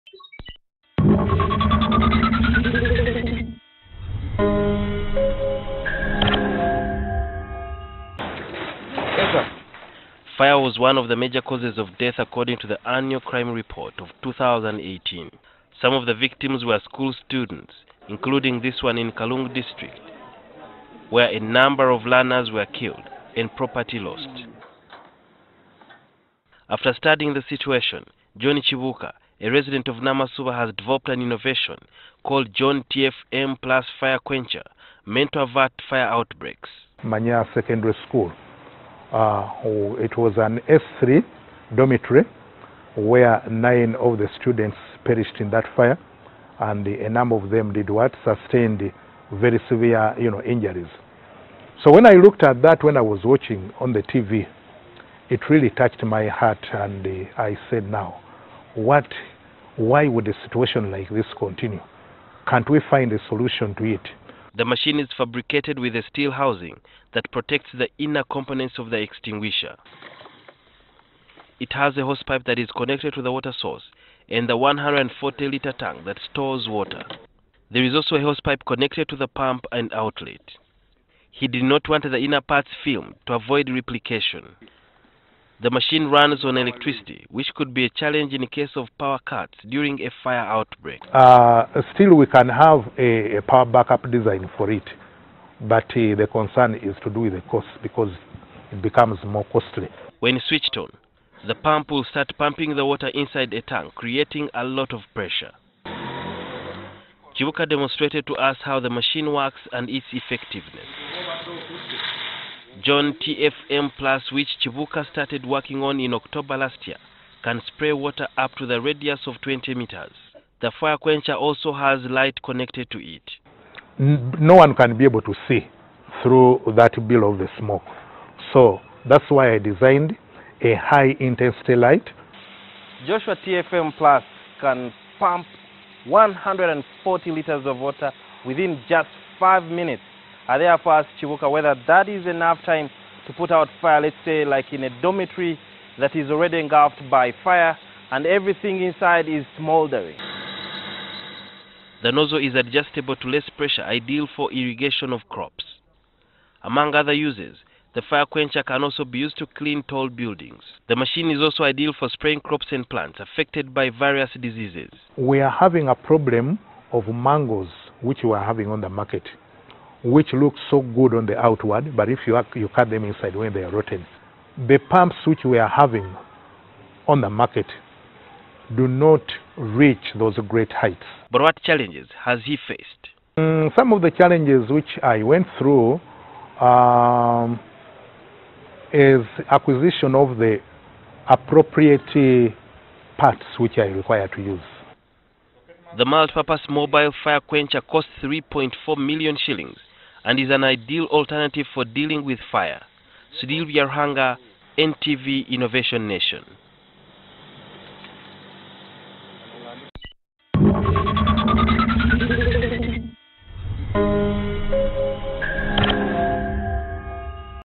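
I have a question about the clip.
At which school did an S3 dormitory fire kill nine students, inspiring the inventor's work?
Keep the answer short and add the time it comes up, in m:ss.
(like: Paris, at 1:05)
Manya Secondary School, at 0:37.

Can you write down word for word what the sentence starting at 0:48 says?
Sustained very severe you know, injuries.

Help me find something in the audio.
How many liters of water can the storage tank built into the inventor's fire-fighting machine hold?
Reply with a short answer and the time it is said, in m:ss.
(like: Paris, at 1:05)
140, at 1:14.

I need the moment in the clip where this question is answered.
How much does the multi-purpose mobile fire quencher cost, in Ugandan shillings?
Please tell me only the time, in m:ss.
3:18.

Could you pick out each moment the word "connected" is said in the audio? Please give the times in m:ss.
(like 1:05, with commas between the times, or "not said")
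1:12, 1:18, 2:02.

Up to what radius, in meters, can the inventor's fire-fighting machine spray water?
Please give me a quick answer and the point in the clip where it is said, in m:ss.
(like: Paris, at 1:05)
20 meters, at 1:59.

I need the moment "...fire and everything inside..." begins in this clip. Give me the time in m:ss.
2:27.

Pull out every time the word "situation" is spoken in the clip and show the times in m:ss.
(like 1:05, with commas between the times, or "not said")
0:27, 1:00.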